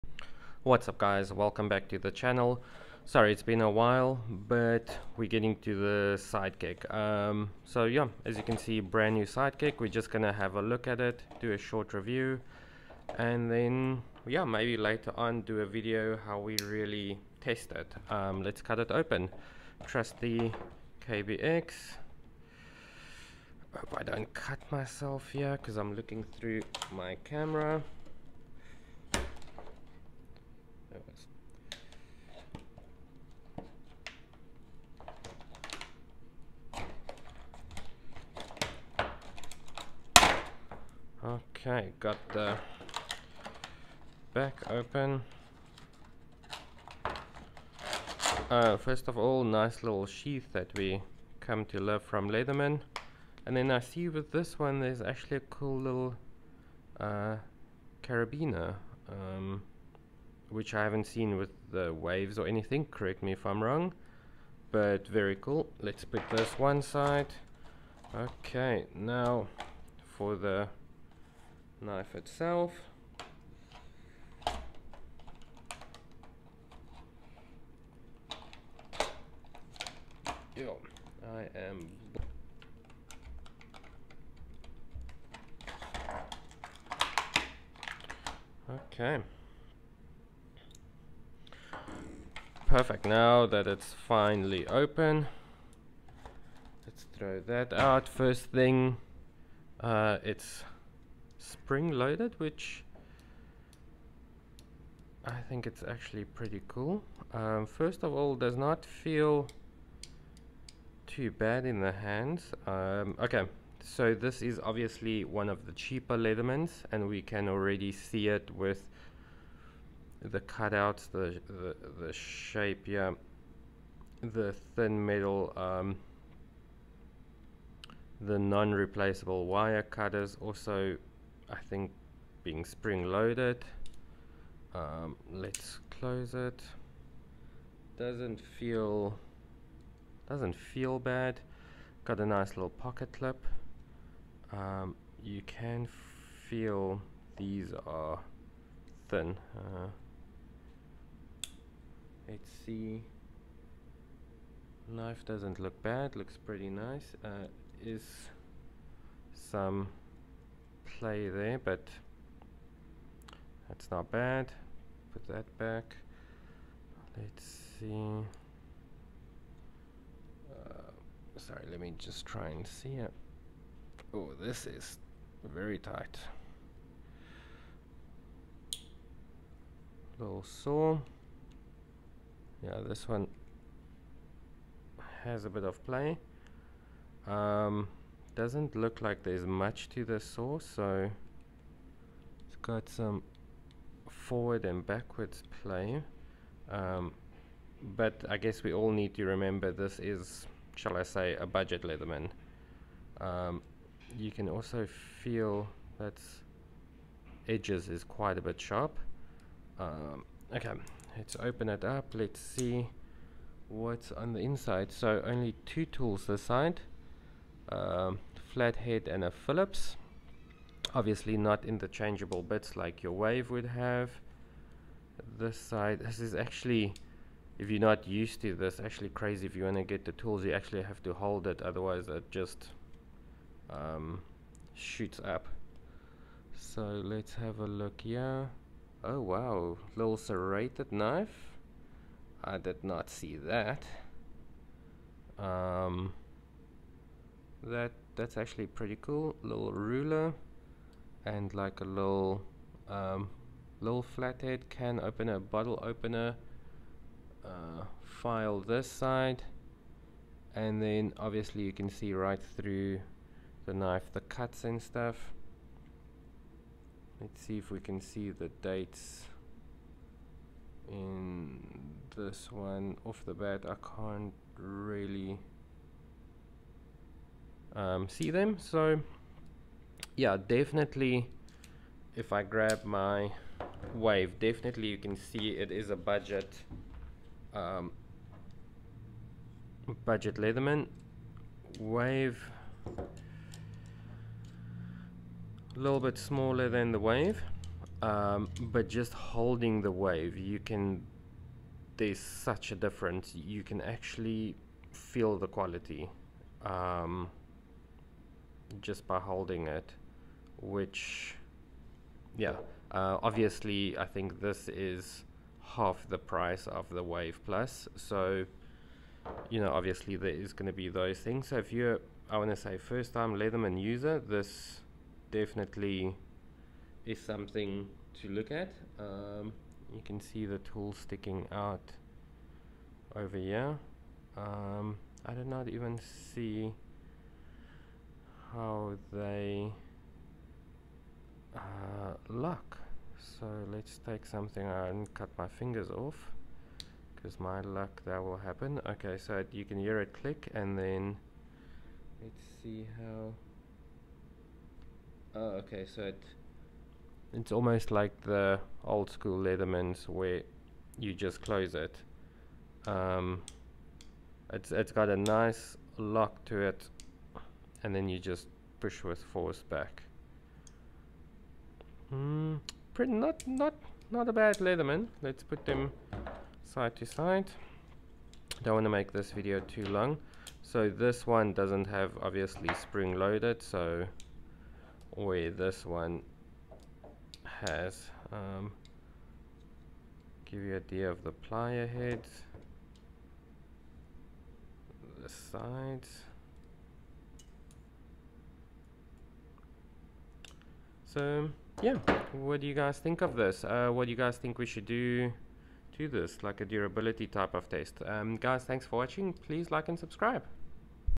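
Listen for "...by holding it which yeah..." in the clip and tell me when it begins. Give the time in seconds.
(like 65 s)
309 s.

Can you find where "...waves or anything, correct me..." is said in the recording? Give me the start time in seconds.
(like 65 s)
61 s.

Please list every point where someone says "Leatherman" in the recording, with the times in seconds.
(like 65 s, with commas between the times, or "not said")
52 s, 116 s, 201 s, 290 s, 323 s, 359 s, 374 s.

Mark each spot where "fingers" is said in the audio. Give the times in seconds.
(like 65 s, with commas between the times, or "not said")
345 s.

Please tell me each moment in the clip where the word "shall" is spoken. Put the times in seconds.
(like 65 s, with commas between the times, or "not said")
200 s.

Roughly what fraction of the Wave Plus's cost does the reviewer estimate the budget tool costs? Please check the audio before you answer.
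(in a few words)
half.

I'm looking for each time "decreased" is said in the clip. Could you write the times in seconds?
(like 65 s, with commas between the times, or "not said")
not said.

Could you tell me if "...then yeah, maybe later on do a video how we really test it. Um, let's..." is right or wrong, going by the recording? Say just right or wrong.
right.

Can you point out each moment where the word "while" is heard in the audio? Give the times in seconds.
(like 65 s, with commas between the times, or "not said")
3 s.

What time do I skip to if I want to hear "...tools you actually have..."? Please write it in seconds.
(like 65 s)
230 s.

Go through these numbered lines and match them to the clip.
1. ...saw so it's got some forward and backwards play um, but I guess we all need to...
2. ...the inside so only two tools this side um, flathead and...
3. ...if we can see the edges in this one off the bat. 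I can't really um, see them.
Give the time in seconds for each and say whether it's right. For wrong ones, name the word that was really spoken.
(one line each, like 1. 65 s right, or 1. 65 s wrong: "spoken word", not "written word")
1. 190 s right
2. 214 s right
3. 267 s wrong: "dates", not "edges".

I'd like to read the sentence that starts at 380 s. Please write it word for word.
So this one doesn't have obviously spring loaded, so way this one has.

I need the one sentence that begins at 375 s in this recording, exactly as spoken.
Let's put them side to side.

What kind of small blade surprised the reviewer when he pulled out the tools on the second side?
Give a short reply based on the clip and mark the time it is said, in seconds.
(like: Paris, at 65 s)
serrated knife, at 240 s.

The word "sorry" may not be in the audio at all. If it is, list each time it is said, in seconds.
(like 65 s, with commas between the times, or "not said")
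3 s, 171 s.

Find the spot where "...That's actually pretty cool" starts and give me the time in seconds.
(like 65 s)
248 s.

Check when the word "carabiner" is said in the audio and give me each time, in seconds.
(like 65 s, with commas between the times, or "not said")
58 s.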